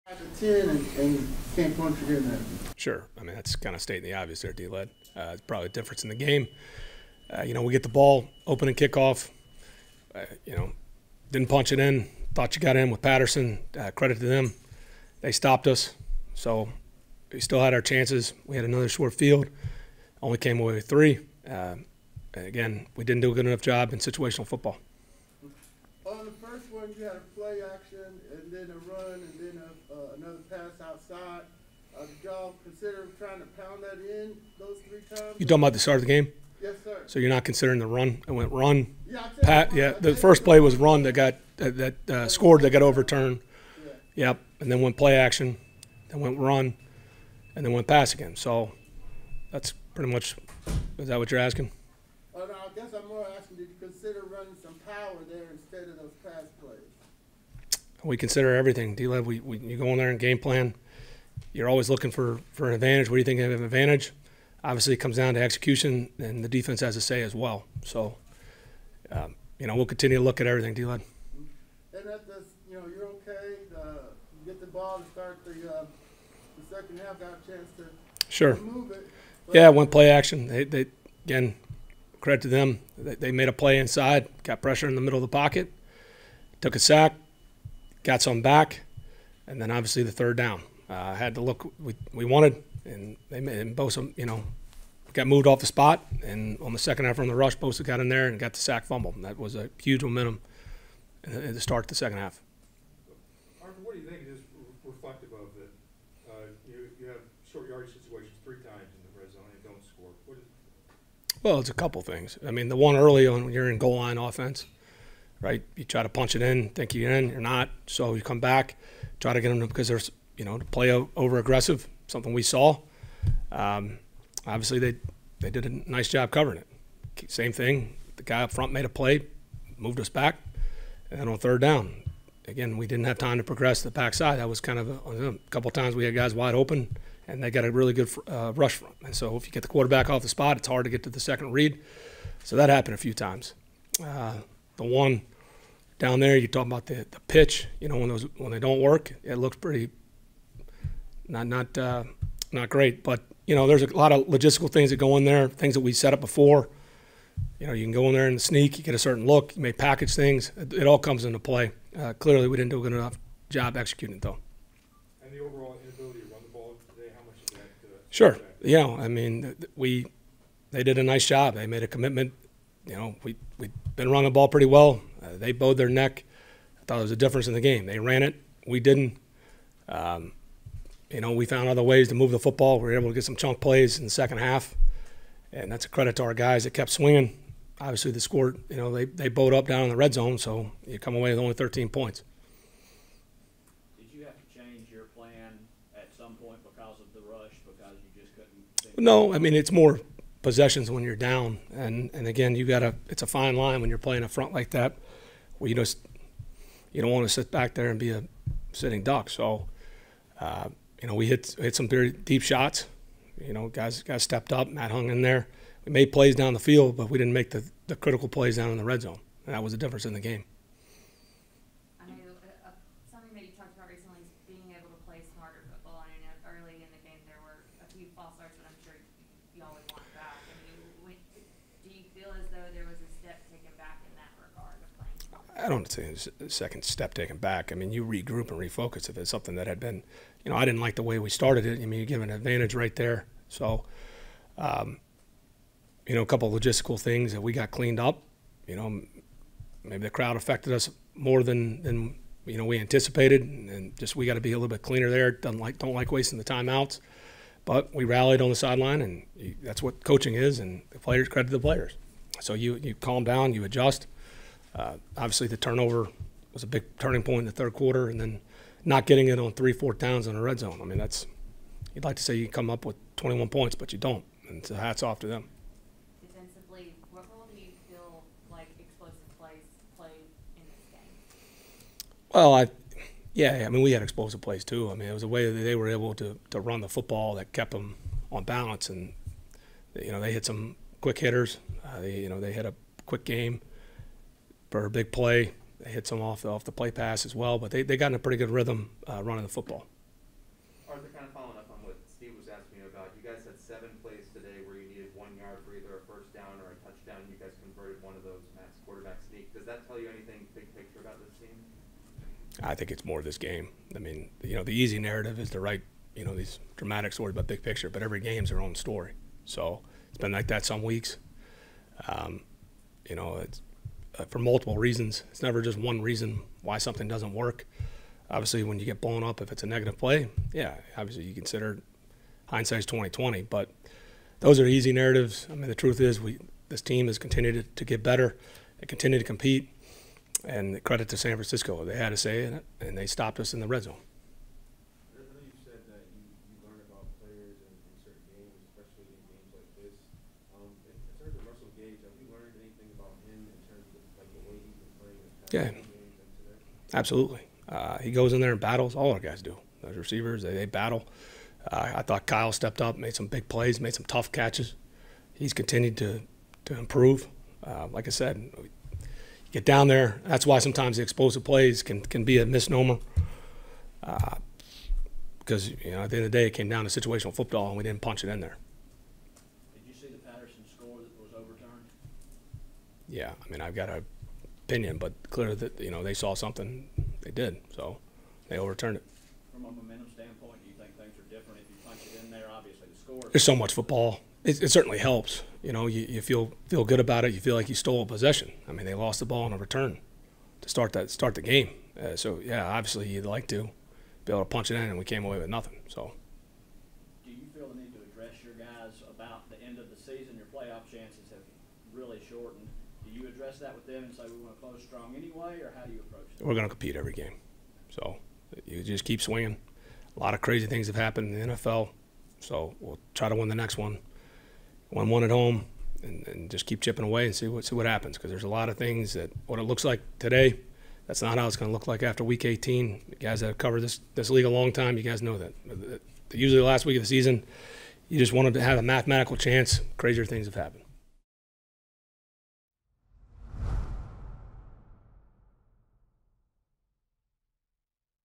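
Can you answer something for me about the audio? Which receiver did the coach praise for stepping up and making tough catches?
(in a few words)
Kyle.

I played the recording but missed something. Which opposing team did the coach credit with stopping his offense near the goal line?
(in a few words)
San Francisco.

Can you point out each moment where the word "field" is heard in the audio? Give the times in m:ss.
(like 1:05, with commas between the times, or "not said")
0:19, 3:36.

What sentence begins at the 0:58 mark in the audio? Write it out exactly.
D-Led, we, we, you go in there and game plan.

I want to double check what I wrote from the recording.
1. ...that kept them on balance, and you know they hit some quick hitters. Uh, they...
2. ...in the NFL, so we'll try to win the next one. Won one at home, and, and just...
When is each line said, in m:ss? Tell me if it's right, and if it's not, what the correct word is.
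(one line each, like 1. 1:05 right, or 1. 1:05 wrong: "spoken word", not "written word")
1. 4:47 right
2. 7:01 right.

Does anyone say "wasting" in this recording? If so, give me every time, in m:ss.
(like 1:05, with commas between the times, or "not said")
4:16.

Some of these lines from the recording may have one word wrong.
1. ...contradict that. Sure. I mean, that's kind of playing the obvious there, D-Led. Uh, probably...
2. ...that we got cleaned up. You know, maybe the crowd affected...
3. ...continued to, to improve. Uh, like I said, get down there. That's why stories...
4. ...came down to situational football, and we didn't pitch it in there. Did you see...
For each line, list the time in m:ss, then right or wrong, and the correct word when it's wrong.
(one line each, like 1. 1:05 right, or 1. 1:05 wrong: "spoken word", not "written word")
1. 0:01 wrong: "stating", not "playing"
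2. 4:07 right
3. 6:05 wrong: "sometimes", not "stories"
4. 6:16 wrong: "punch", not "pitch".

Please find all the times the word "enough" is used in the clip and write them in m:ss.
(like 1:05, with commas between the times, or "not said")
0:23, 2:42.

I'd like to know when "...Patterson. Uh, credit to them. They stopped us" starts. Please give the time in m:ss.
0:13.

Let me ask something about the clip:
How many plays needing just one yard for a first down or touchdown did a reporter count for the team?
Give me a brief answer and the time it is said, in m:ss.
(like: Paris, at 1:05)
7, at 5:03.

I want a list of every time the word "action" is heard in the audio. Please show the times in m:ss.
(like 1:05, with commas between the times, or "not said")
0:45, 1:20.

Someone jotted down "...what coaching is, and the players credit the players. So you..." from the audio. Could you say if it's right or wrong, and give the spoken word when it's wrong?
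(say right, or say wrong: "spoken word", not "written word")
right.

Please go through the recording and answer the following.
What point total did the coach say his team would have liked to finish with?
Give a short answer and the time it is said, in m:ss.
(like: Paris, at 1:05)
21, at 4:33.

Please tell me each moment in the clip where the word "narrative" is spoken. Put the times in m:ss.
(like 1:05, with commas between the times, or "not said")
5:14, 5:34.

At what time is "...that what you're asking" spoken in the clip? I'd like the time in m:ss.
0:51.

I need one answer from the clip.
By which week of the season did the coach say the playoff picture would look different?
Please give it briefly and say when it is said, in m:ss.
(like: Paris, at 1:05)
Week 18, at 7:12.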